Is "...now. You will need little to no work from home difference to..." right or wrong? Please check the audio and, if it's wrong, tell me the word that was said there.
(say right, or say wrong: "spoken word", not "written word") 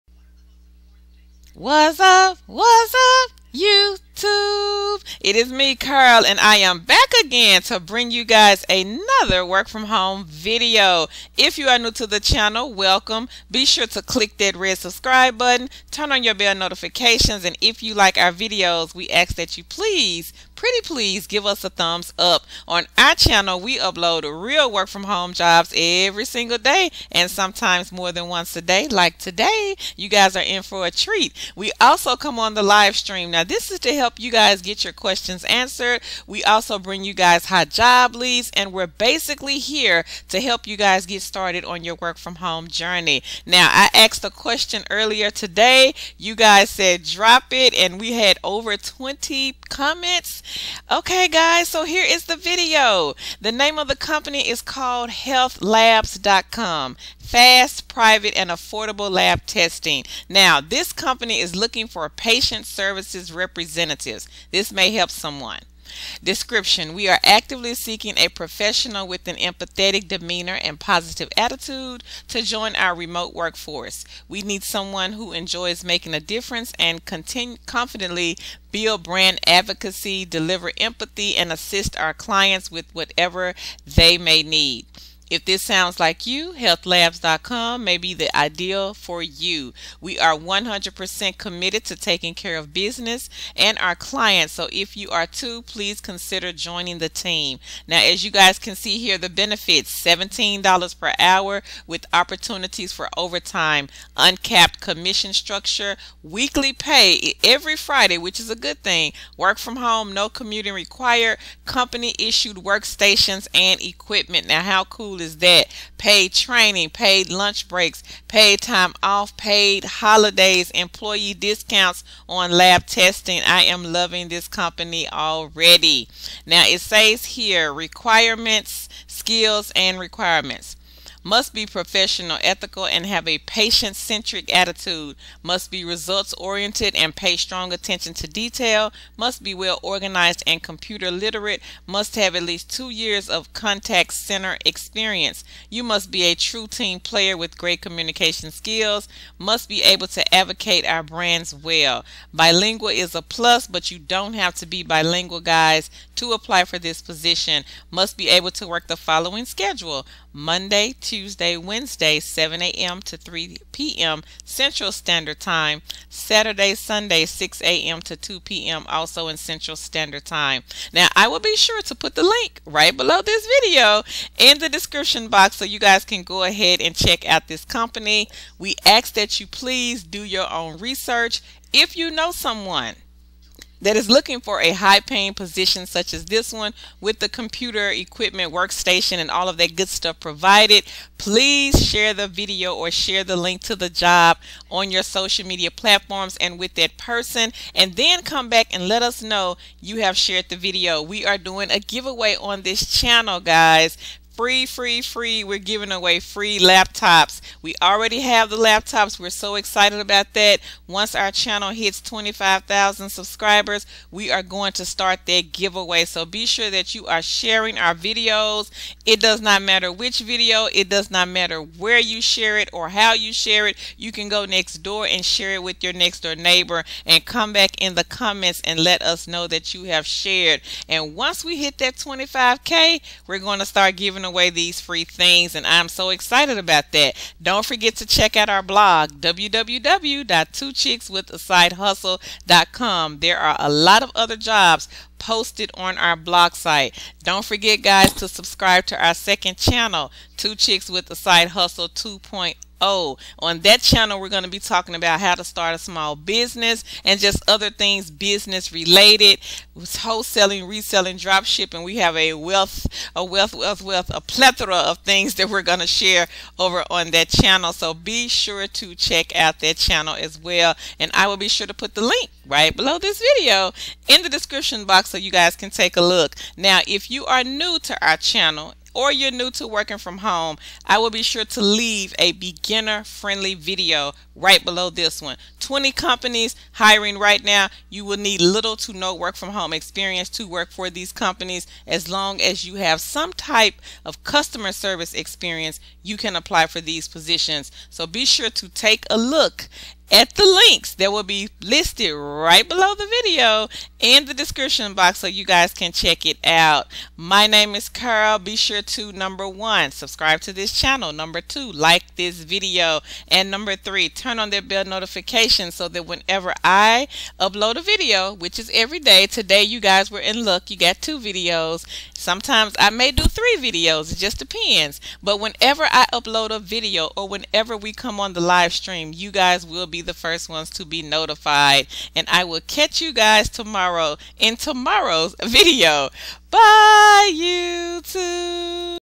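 wrong: "experience", not "difference".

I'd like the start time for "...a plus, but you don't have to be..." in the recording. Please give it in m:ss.
2:33.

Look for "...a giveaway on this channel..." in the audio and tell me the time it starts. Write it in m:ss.
3:21.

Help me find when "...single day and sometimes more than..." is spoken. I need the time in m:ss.
0:26.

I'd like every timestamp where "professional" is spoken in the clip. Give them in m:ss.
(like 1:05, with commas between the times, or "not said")
1:08, 2:11.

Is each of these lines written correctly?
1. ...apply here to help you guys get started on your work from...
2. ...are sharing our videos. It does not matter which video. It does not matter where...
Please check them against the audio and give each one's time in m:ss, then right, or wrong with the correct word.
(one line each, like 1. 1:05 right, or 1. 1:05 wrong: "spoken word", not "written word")
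1. 0:38 wrong: "basically", not "apply"
2. 3:37 right.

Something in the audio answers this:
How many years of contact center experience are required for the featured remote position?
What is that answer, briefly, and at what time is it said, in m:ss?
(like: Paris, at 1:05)
2 years, at 2:22.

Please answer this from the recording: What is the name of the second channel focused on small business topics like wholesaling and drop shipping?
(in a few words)
Two Chicks with a Side Hustle 2.0.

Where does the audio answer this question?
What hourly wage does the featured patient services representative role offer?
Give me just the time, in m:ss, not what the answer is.
1:40.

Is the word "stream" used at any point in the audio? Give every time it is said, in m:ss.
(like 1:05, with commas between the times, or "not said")
0:32, 5:28.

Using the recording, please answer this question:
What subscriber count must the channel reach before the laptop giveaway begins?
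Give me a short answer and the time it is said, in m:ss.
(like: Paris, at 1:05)
25,000, at 3:32.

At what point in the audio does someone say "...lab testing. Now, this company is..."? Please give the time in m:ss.
0:59.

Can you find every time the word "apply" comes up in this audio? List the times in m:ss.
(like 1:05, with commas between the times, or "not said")
2:36, 4:56.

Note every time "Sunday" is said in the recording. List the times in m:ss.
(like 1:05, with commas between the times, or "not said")
2:46.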